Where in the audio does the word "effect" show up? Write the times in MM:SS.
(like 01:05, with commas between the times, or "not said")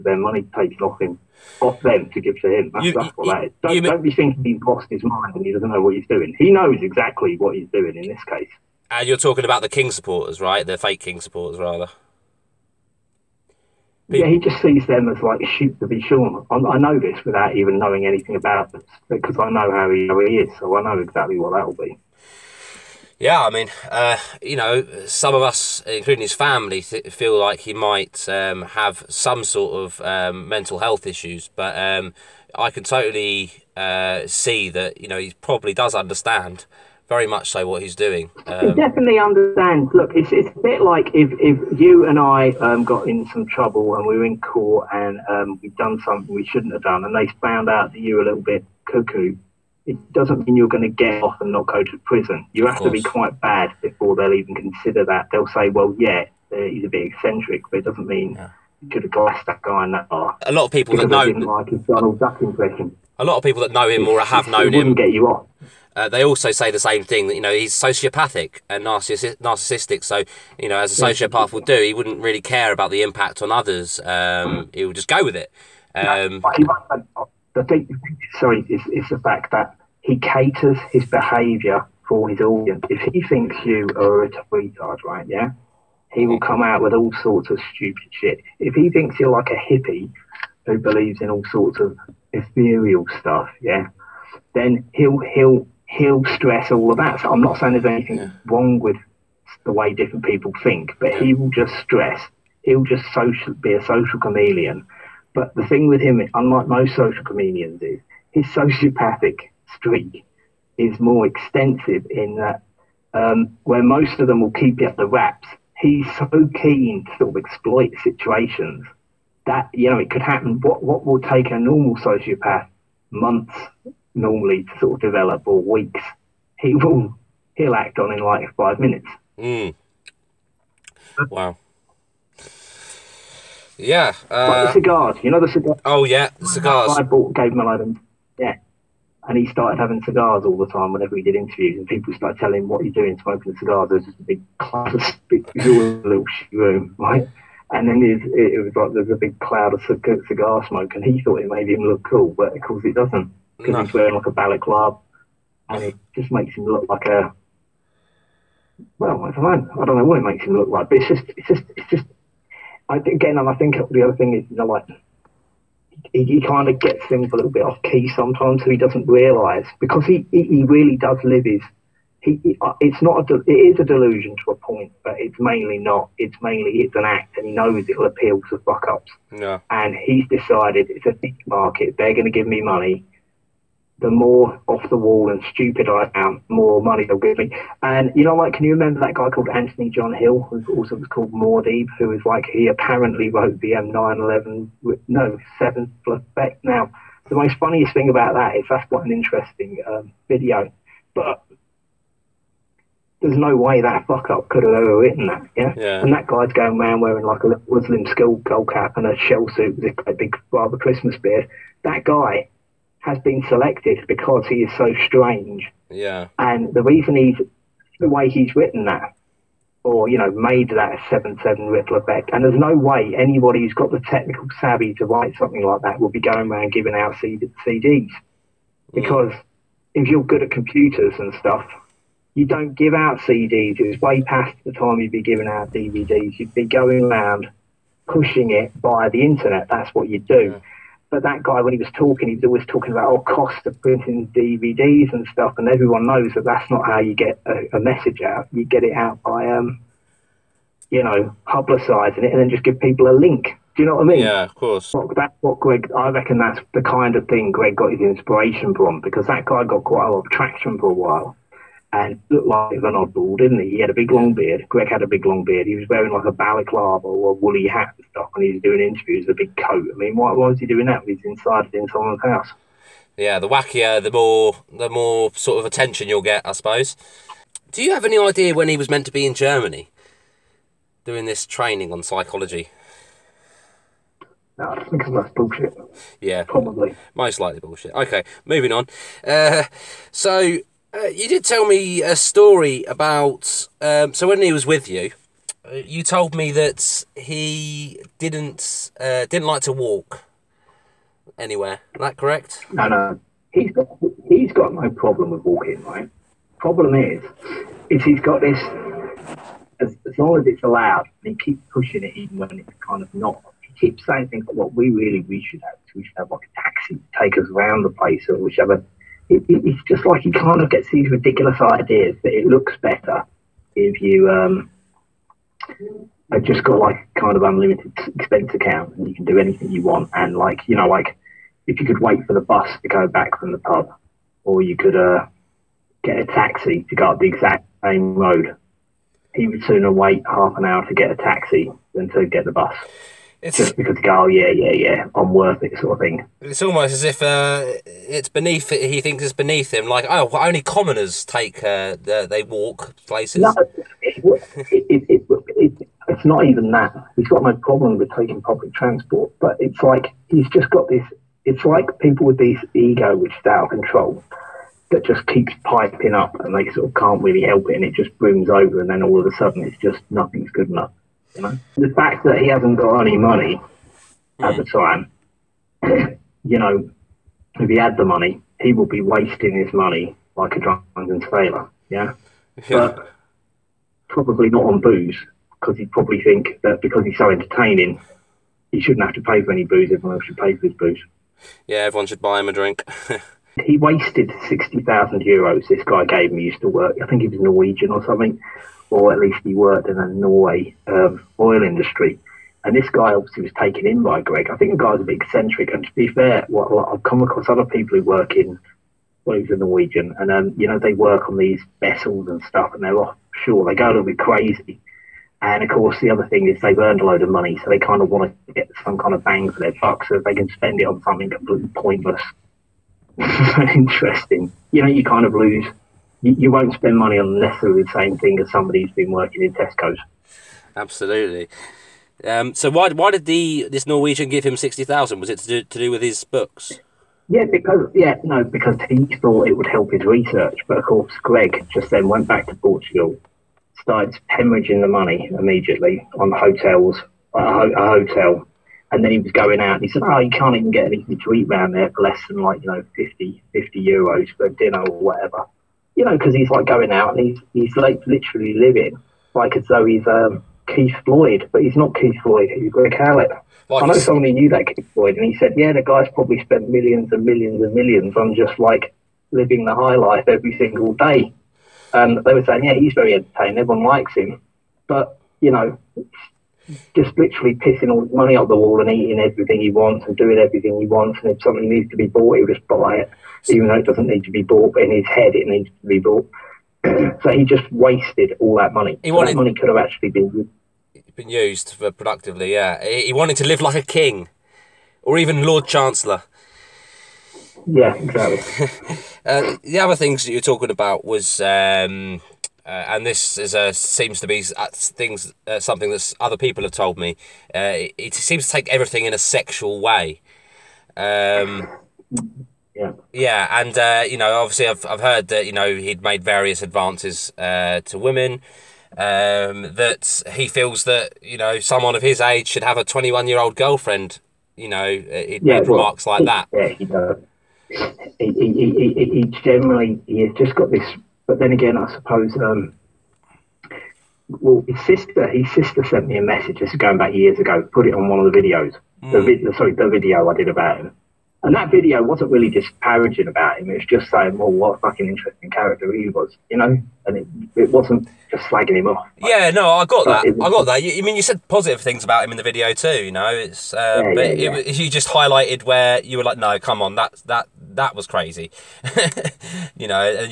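03:16, 03:41.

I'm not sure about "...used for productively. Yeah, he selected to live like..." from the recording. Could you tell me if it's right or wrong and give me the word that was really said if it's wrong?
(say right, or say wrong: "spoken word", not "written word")
wrong: "wanted", not "selected".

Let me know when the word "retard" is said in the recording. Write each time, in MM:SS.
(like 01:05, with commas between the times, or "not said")
01:24.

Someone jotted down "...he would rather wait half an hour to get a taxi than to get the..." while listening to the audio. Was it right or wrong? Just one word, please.
wrong.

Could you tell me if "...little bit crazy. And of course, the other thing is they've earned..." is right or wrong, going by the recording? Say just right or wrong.
right.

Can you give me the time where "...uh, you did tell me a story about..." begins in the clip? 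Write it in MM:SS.
04:50.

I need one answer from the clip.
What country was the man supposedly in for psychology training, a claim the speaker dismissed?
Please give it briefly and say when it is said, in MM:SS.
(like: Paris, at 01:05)
Germany, at 04:39.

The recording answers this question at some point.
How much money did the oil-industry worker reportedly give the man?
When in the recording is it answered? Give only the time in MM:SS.
06:34.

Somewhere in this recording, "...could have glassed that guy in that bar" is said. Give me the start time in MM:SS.
00:58.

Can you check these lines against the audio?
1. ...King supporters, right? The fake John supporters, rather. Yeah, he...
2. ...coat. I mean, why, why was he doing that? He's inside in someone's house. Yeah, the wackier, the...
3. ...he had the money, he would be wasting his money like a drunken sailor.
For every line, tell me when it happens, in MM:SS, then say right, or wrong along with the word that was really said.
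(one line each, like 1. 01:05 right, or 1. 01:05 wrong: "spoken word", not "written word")
1. 00:09 wrong: "King", not "John"
2. 04:29 right
3. 06:17 right.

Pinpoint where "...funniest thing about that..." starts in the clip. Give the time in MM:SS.
03:17.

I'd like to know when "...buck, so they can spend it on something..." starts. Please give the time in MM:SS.
06:59.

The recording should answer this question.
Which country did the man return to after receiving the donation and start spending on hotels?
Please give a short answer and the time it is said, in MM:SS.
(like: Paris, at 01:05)
Portugal, at 07:22.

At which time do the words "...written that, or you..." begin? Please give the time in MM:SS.
03:38.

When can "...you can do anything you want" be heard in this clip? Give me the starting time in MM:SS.
05:29.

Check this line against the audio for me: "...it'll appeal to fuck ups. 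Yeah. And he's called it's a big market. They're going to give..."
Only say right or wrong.
wrong.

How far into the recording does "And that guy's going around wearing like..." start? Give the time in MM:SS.
03:26.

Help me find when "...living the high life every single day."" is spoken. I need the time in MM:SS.
07:49.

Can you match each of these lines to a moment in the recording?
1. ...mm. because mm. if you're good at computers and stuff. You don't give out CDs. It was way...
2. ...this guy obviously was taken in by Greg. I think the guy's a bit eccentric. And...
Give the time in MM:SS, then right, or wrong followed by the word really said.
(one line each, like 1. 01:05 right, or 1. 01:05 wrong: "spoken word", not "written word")
1. 03:47 right
2. 06:42 right.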